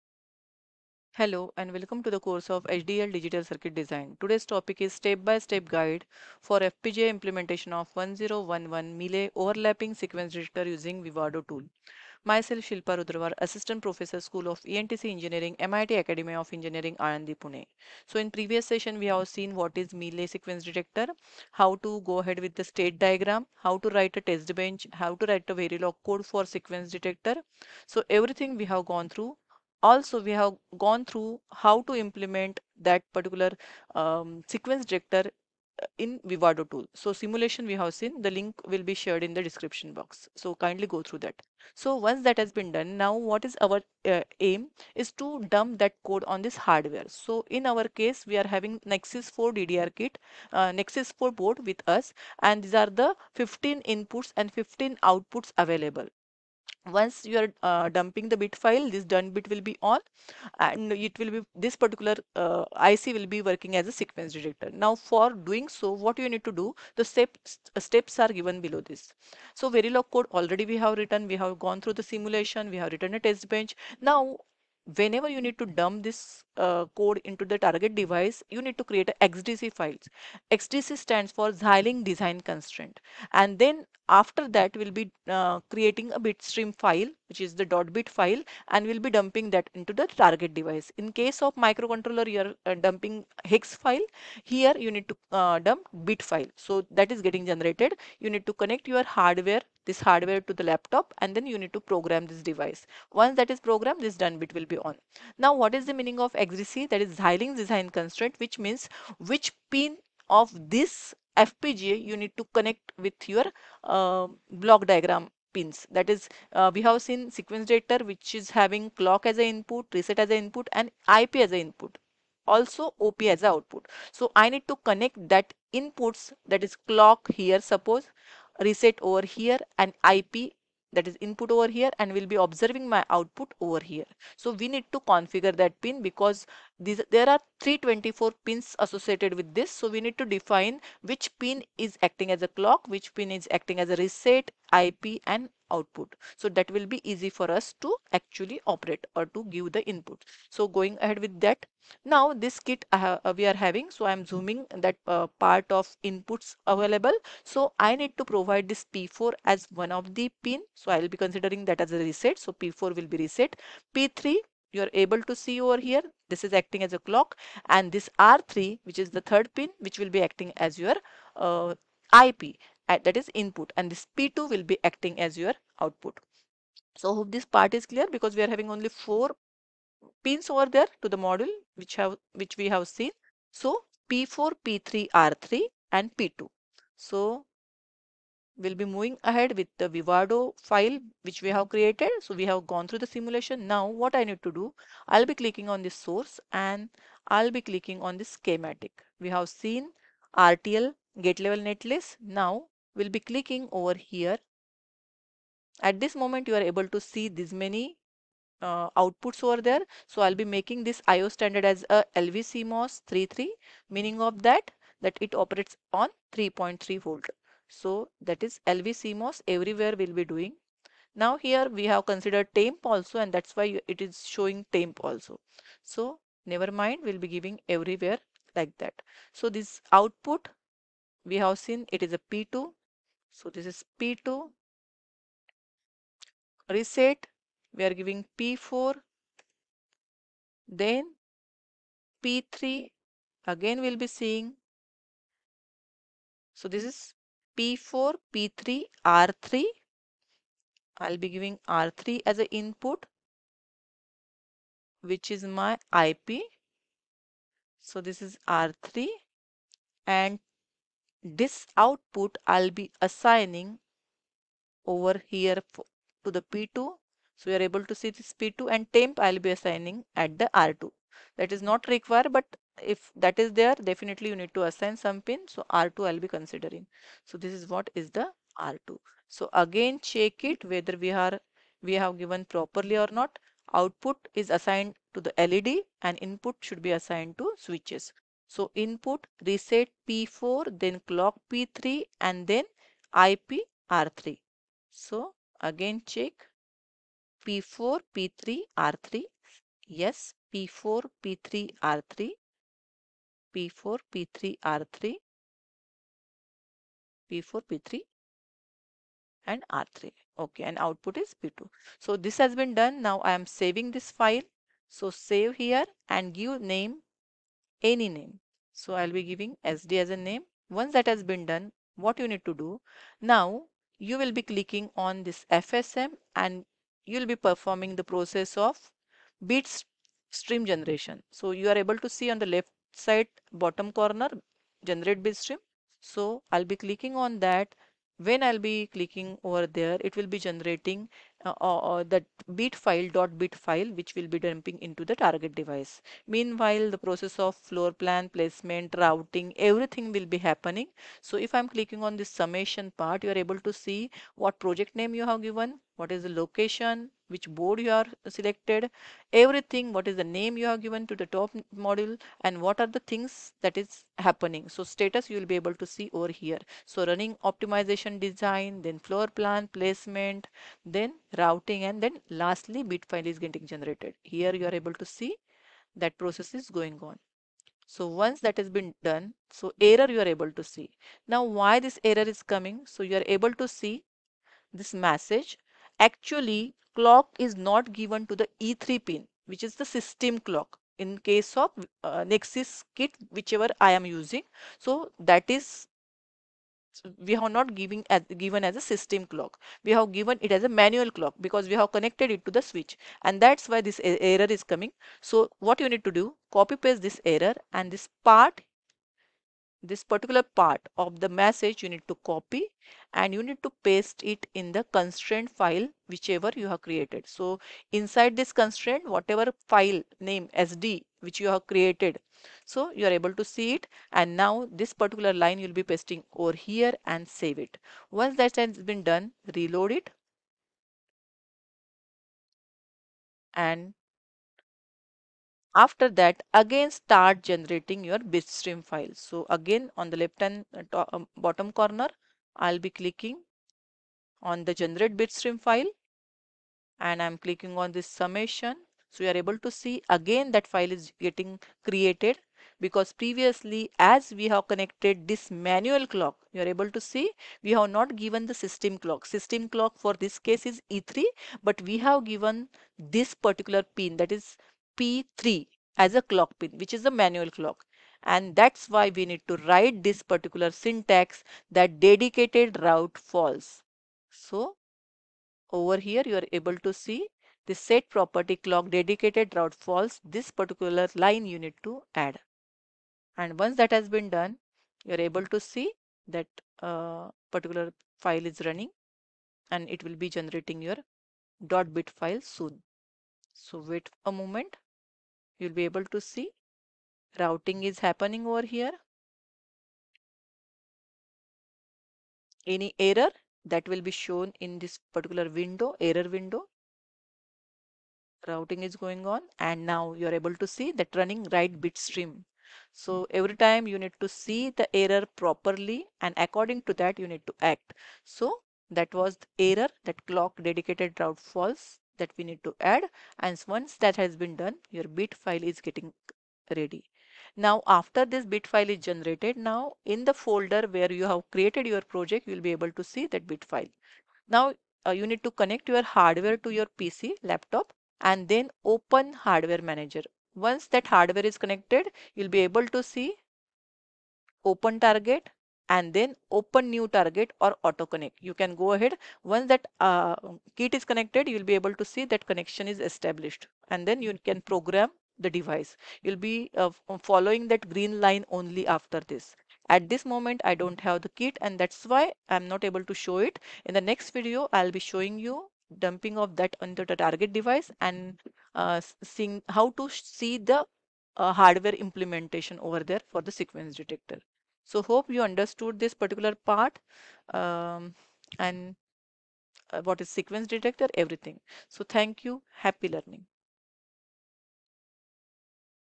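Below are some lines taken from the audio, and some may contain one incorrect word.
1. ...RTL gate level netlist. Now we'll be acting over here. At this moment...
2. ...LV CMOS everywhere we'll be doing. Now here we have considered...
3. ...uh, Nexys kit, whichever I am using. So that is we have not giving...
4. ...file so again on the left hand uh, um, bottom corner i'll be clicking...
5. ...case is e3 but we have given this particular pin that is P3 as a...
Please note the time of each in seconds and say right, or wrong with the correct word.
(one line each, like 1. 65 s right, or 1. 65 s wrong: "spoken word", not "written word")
1. 200 s wrong: "clicking", not "acting"
2. 218 s right
3. 392 s right
4. 438 s right
5. 460 s right.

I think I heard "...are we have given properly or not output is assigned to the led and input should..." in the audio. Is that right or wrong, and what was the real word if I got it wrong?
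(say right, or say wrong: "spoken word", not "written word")
right.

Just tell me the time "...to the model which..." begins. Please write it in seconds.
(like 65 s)
181 s.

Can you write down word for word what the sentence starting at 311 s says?
So this has been done now I am saving this file so save here and give name any name.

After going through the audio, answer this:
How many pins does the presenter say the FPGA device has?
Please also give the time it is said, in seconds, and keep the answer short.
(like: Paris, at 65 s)
324, at 137 s.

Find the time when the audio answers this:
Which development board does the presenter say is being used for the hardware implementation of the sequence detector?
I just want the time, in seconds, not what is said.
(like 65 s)
48 s.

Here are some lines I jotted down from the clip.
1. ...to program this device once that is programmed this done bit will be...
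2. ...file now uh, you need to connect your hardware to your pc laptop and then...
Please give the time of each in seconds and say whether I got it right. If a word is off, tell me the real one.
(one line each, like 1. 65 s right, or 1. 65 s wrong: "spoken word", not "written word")
1. 101 s right
2. 533 s right.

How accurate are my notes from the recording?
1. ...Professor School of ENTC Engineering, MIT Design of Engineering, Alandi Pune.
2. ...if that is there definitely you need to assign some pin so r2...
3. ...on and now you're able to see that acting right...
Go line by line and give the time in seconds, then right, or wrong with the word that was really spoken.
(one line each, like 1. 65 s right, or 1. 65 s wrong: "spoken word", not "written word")
1. 13 s wrong: "Academy", not "Design"
2. 272 s right
3. 509 s wrong: "running", not "acting".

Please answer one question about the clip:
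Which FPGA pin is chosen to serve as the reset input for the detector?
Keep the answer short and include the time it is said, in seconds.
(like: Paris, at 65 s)
P4, at 162 s.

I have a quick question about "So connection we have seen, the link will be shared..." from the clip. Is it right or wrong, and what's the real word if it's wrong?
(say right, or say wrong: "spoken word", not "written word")
wrong: "simulation", not "connection".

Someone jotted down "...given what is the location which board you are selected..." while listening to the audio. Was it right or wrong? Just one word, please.
right.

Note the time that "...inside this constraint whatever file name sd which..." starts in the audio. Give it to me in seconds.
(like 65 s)
417 s.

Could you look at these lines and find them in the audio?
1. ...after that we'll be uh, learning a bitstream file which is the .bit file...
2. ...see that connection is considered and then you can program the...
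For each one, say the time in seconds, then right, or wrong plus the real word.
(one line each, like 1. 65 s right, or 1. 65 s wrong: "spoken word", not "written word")
1. 84 s wrong: "creating", not "learning"
2. 552 s wrong: "established", not "considered".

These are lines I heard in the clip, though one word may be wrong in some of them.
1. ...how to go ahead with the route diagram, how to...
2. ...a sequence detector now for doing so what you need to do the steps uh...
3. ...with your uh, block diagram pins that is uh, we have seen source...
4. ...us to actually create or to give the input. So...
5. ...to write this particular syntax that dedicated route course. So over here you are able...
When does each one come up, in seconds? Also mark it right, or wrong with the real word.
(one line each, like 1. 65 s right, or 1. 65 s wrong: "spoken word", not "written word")
1. 21 s wrong: "state", not "route"
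2. 63 s right
3. 112 s wrong: "sequence", not "source"
4. 147 s wrong: "operate", not "create"
5. 469 s wrong: "false", not "course".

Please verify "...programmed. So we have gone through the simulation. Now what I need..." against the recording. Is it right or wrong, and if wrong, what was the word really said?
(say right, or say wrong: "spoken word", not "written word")
wrong: "created", not "programmed".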